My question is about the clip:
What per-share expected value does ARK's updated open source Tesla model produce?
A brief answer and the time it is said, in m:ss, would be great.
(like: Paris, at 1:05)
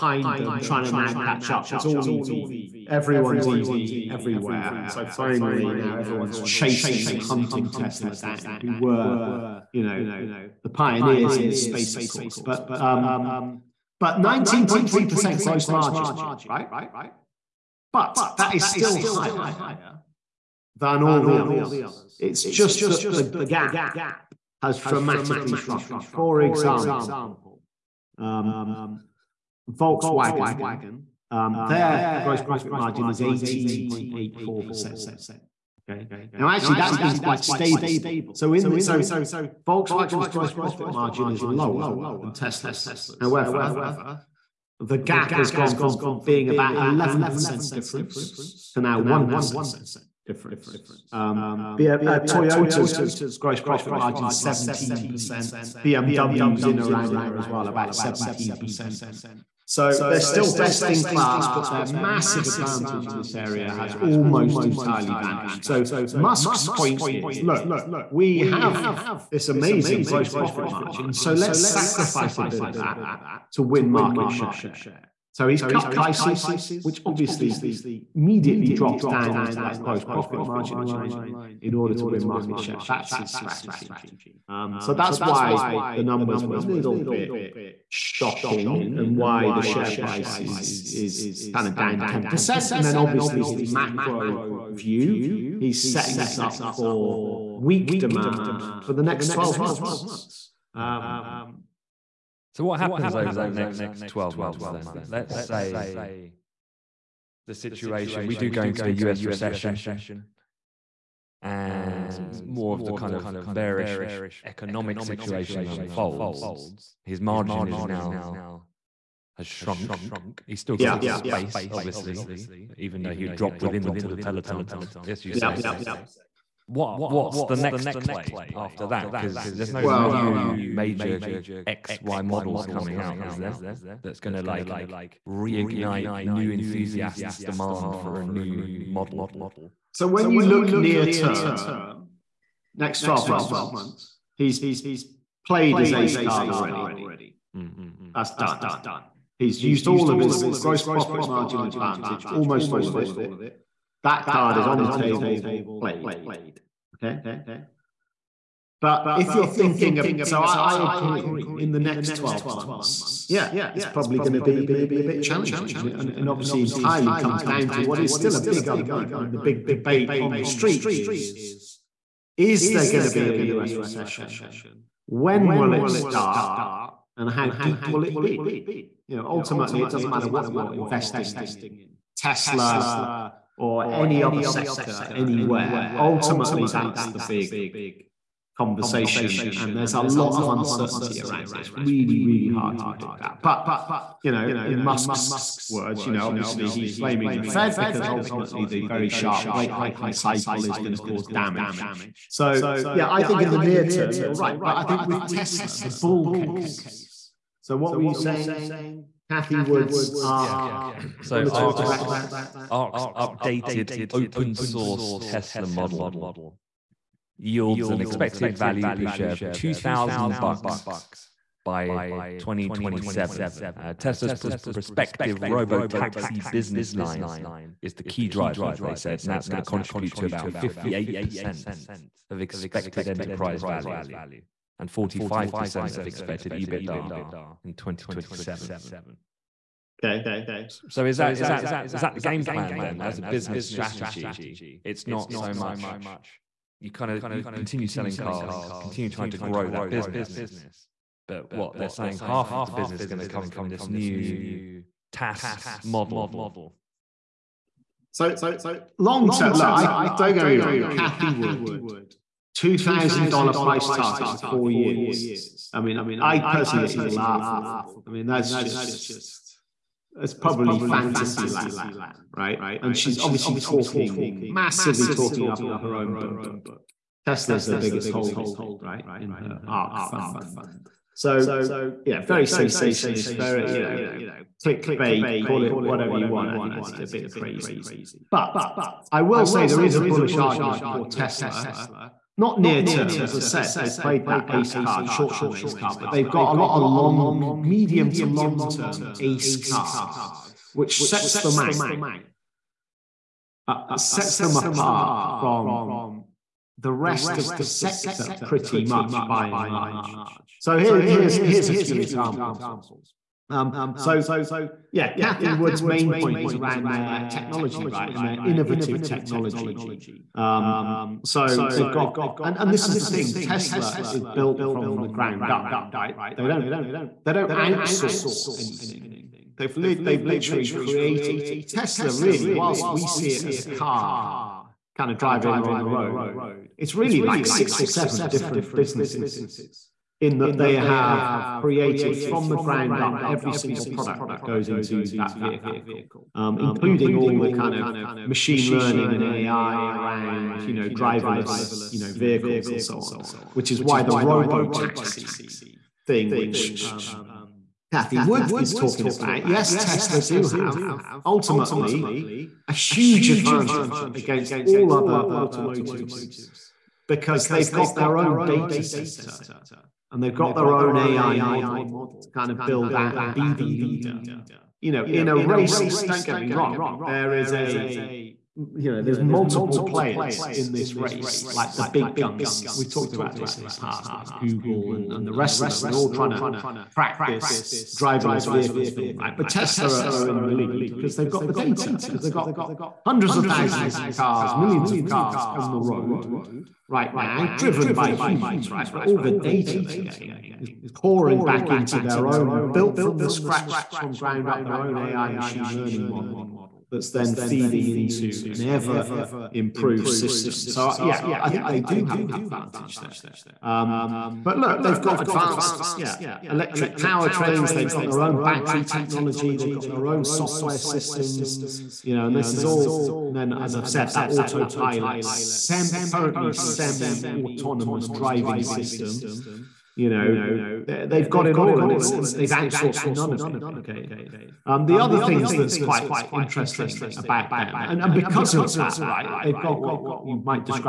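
$2,000, at 3:39.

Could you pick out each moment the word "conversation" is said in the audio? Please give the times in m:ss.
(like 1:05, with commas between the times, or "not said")
3:08.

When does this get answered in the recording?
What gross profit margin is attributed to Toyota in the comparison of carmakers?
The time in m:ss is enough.
0:52.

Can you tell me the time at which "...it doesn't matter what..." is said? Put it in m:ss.
2:59.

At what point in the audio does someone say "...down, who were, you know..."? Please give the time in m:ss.
0:08.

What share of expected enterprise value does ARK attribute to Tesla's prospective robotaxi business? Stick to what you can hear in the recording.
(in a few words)
58%.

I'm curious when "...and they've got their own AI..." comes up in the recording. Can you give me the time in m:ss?
6:10.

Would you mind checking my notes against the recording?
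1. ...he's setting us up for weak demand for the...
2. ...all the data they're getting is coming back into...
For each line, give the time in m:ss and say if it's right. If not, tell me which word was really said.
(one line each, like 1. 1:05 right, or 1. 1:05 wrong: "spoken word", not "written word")
1. 1:35 right
2. 6:39 wrong: "pouring", not "coming".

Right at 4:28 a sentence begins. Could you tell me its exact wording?
I mean, that's just, it's probably fantasy land, right?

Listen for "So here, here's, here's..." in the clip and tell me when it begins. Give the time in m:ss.
5:10.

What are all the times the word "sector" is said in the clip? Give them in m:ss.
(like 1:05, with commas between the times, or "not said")
3:04, 5:07.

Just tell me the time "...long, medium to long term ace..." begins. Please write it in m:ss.
4:56.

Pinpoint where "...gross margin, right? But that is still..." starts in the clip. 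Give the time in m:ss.
0:15.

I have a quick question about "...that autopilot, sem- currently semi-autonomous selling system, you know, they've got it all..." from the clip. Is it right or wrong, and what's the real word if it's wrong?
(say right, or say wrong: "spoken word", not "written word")
wrong: "driving", not "selling".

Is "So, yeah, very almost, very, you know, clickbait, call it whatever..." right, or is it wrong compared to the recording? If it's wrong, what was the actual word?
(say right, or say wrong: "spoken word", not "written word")
wrong: "sensationalist", not "almost".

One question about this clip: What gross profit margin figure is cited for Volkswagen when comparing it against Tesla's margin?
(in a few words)
18.84%.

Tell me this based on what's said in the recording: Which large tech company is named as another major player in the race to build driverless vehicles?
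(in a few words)
Google.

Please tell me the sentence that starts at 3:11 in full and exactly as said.
It's really, really hard to predict that.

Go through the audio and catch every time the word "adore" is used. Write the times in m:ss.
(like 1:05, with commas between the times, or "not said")
not said.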